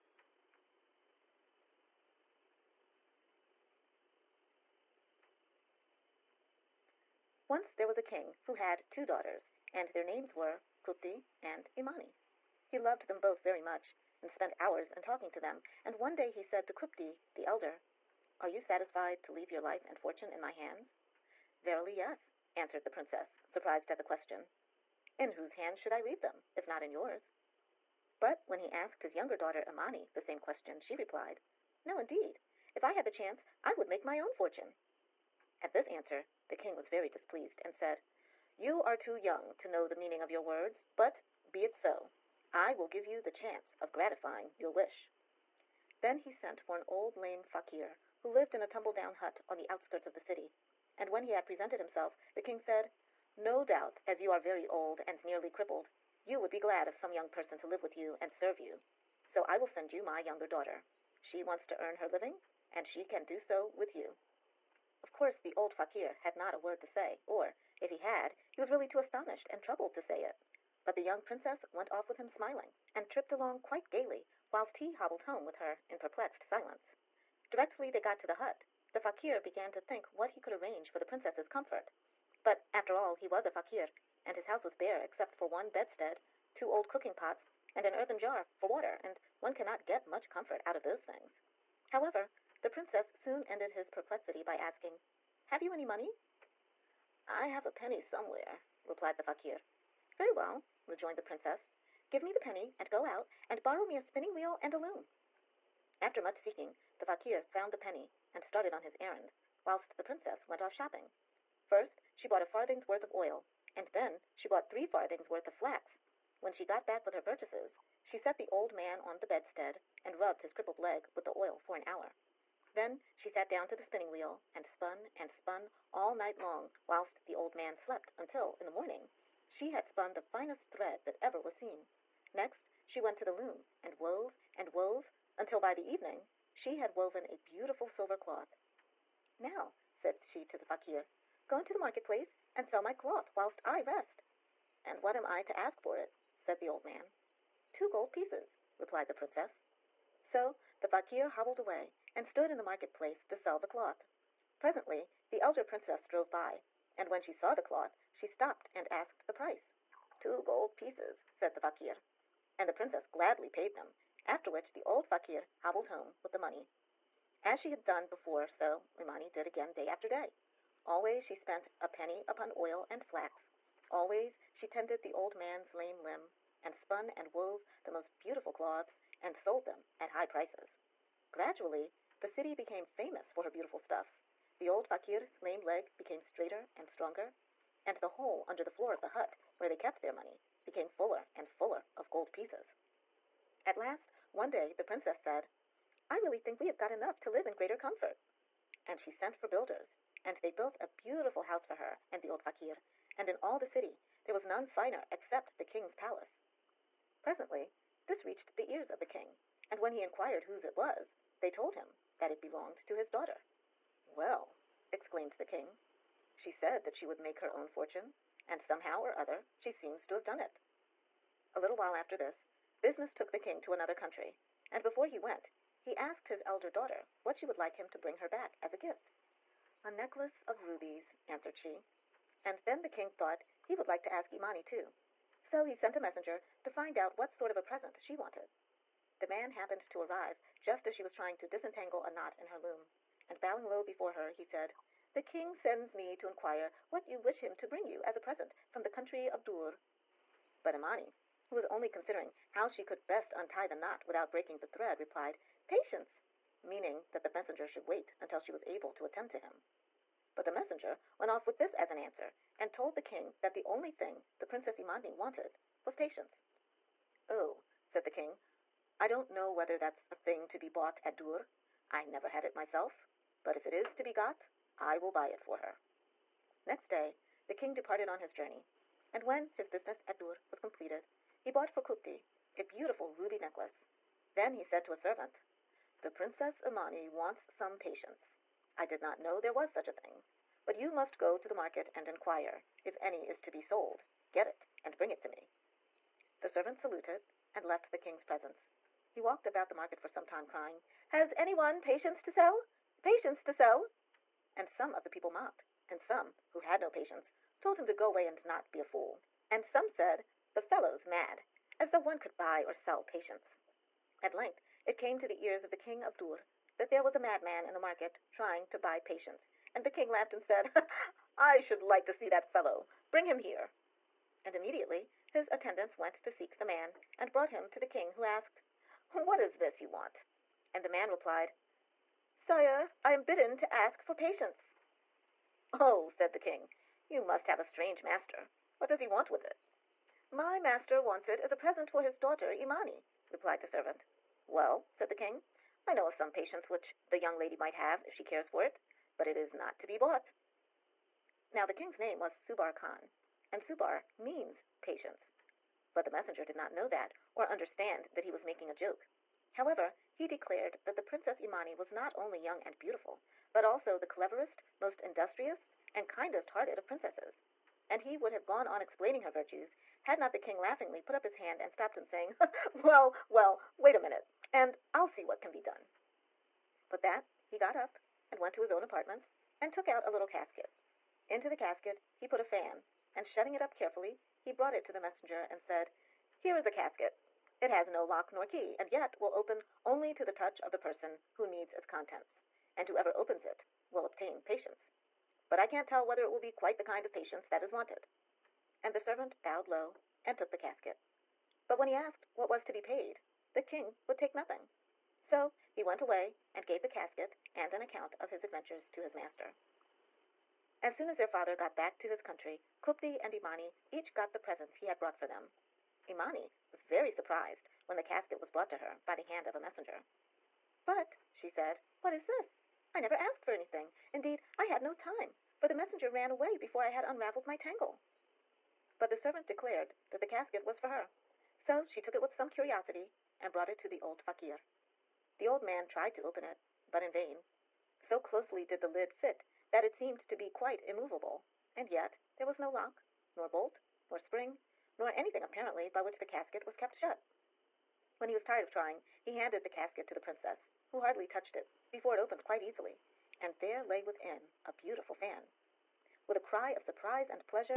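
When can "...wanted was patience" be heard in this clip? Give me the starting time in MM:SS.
04:25.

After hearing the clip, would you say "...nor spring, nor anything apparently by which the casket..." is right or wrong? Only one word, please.
right.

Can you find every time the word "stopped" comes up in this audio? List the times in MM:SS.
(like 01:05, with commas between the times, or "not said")
02:38, 06:11.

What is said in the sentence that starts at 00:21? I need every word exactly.
Verily, yes, answered the princess, surprised at the question.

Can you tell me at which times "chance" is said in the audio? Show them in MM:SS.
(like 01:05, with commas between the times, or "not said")
00:33, 00:43.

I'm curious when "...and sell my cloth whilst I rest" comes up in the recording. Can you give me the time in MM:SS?
02:22.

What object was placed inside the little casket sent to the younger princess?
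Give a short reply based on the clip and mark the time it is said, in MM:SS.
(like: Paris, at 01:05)
A fan, at 06:22.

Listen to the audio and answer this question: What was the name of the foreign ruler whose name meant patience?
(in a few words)
Subar Khan.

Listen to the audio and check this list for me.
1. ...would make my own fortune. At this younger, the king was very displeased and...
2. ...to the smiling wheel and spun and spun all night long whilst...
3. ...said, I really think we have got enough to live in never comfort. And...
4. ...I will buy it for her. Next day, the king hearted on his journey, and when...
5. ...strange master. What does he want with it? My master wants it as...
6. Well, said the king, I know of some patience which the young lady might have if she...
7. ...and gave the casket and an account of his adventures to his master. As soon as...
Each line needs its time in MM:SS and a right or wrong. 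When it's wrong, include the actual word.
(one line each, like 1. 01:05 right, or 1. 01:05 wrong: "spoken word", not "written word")
1. 00:33 wrong: "answer", not "younger"
2. 02:03 wrong: "spinning", not "smiling"
3. 03:15 wrong: "greater", not "never"
4. 04:34 wrong: "departed", not "hearted"
5. 05:37 right
6. 05:44 right
7. 06:46 right.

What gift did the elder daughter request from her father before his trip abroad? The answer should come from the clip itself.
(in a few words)
A necklace of rubies.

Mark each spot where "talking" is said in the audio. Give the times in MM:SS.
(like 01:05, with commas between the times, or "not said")
00:15.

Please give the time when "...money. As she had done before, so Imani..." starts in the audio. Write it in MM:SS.
02:46.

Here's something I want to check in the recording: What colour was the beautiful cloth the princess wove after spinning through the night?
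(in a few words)
Silver.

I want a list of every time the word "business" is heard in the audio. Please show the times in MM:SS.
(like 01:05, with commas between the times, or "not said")
03:42, 04:39.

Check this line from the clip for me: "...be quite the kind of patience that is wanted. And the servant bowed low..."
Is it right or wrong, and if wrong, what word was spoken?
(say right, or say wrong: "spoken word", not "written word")
right.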